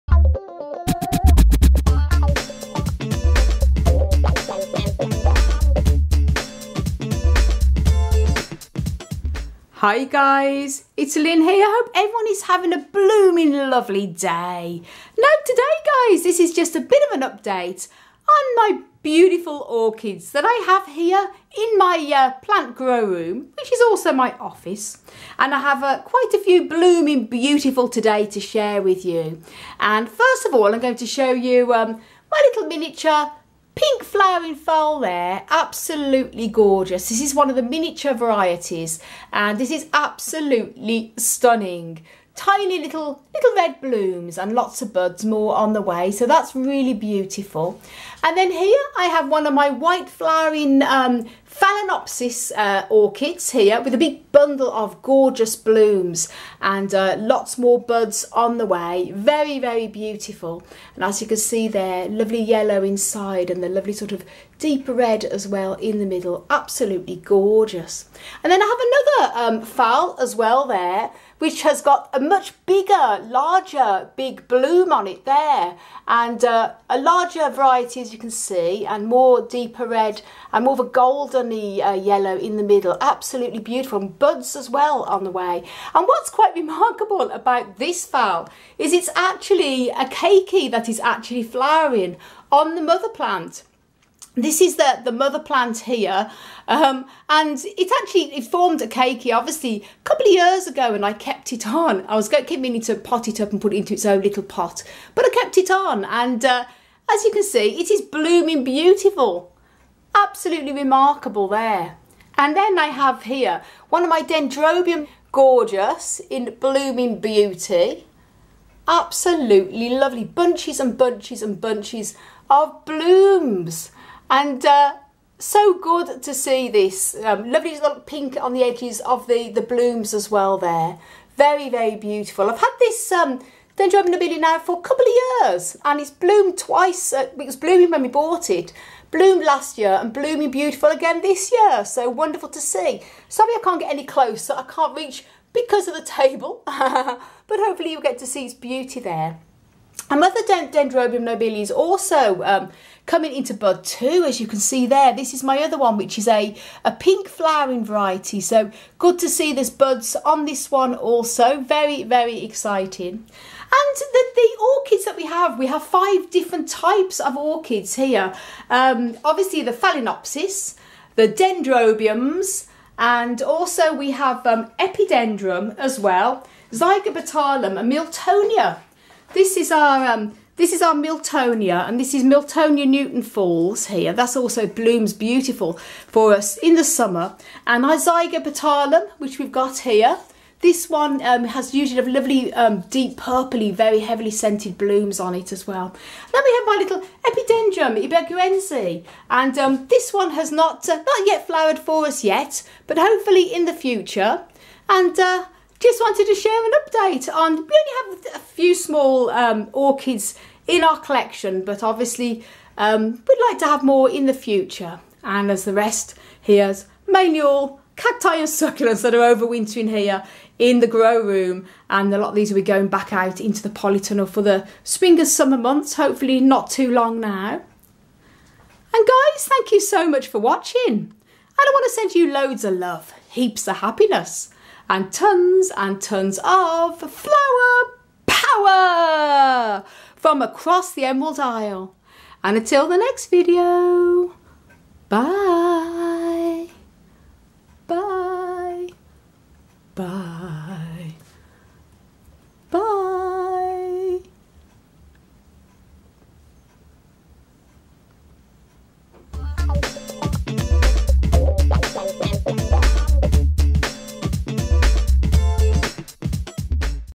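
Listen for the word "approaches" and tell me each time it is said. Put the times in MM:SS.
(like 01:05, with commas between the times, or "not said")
not said.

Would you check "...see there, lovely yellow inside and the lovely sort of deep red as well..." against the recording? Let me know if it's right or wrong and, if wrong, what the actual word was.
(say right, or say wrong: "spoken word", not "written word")
right.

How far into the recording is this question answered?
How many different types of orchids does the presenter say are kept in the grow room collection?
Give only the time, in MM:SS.
02:45.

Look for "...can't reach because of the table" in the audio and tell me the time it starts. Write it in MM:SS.
02:24.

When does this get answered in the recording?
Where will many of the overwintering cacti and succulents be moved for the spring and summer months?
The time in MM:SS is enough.
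03:43.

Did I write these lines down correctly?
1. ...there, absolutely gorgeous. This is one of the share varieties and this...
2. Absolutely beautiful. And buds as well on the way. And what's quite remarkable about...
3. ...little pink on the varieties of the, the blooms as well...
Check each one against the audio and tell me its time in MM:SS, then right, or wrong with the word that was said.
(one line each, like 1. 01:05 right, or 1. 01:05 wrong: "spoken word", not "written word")
1. 00:35 wrong: "miniature", not "share"
2. 01:23 right
3. 02:07 wrong: "edges", not "varieties".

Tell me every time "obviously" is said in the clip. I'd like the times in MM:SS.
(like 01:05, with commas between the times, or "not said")
01:39, 02:49, 03:31.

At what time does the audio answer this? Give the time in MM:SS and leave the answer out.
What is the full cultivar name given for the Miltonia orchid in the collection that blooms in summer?
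03:02.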